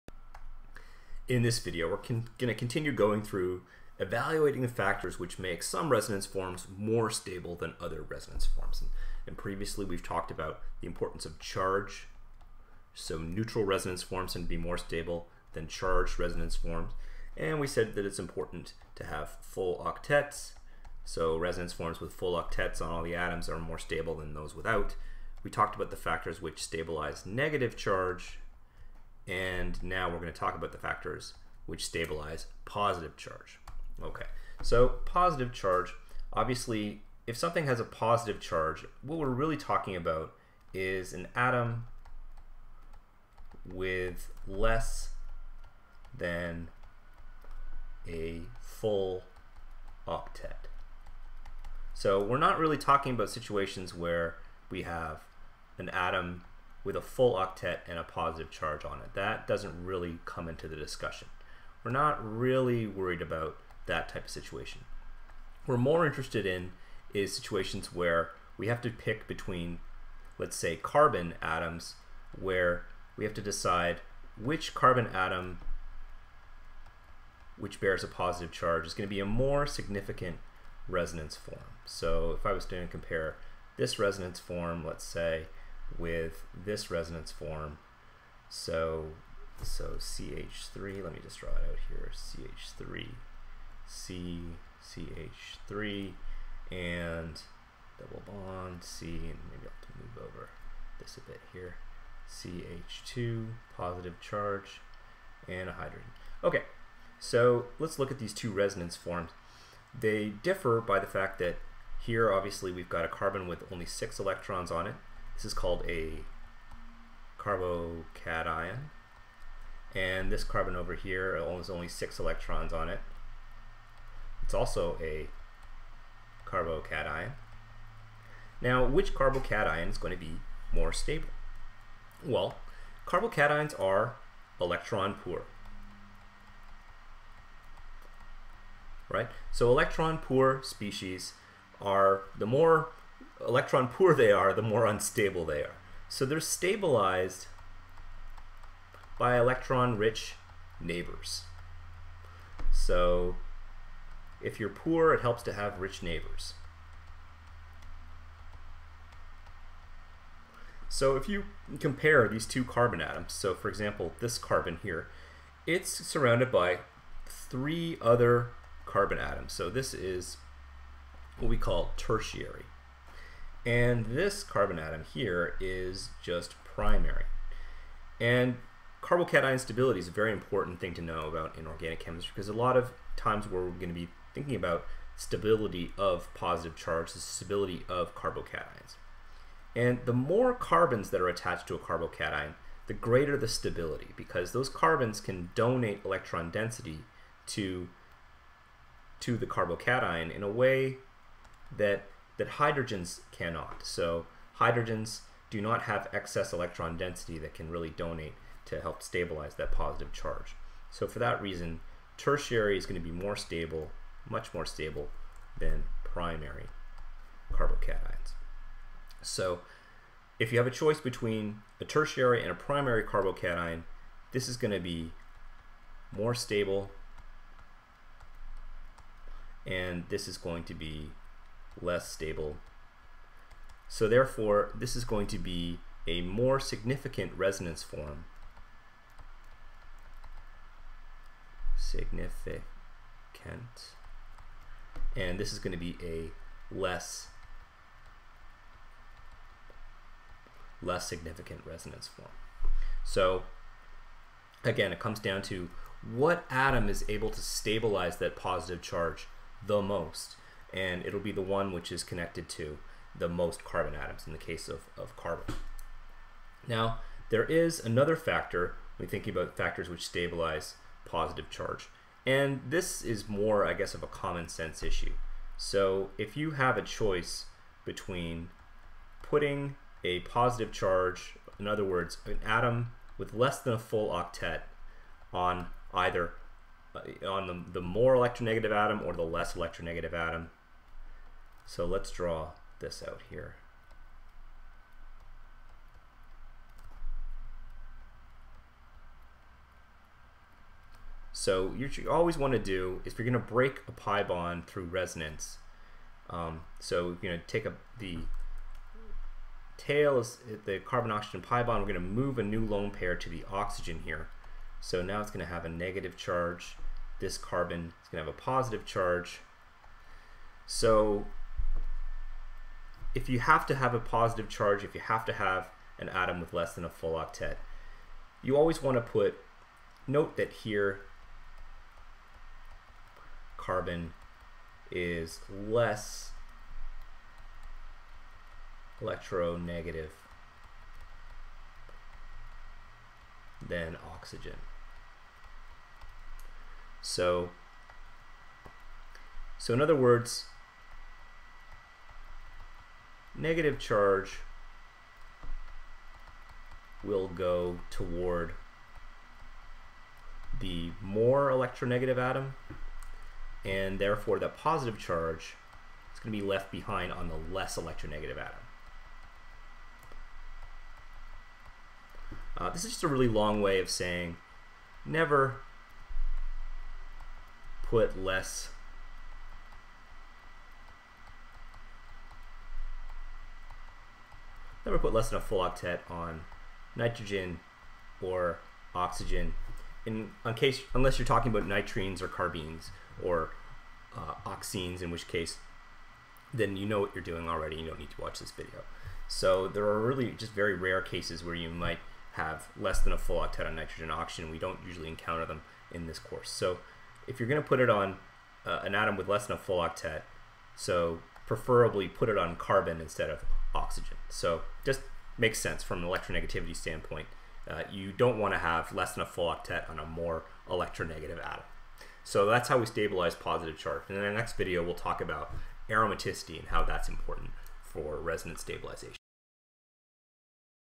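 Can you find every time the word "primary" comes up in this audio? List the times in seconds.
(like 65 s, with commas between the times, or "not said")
176 s, 216 s, 222 s.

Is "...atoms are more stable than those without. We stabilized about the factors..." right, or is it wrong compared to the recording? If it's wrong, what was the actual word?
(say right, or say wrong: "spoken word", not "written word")
wrong: "talked", not "stabilized".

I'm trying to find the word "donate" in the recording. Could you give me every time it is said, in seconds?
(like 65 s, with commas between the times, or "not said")
195 s, 207 s.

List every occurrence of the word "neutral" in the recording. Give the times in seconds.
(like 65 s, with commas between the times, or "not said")
13 s.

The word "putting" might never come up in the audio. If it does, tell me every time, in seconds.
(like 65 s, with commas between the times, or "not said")
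279 s.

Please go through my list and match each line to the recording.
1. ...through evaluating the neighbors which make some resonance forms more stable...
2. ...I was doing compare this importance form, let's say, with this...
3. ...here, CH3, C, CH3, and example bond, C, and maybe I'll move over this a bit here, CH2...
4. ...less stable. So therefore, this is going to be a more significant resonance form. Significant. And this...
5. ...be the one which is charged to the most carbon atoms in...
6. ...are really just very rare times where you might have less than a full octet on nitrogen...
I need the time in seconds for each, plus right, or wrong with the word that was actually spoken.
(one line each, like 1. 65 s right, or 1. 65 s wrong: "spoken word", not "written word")
1. 3 s wrong: "factors", not "neighbors"
2. 82 s wrong: "resonance", not "importance"
3. 91 s wrong: "double", not "example"
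4. 231 s right
5. 261 s wrong: "connected", not "charged"
6. 399 s wrong: "cases", not "times".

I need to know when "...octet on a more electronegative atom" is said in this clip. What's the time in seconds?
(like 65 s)
419 s.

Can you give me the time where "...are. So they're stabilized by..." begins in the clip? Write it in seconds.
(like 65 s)
145 s.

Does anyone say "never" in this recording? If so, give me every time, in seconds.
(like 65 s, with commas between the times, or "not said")
375 s, 384 s.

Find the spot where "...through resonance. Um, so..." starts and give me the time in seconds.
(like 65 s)
304 s.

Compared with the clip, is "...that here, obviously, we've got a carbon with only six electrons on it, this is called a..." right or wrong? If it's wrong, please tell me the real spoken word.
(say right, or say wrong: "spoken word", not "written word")
right.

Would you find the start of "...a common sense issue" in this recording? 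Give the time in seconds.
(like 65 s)
274 s.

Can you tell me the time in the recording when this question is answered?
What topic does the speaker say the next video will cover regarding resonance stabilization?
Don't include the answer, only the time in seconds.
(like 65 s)
425 s.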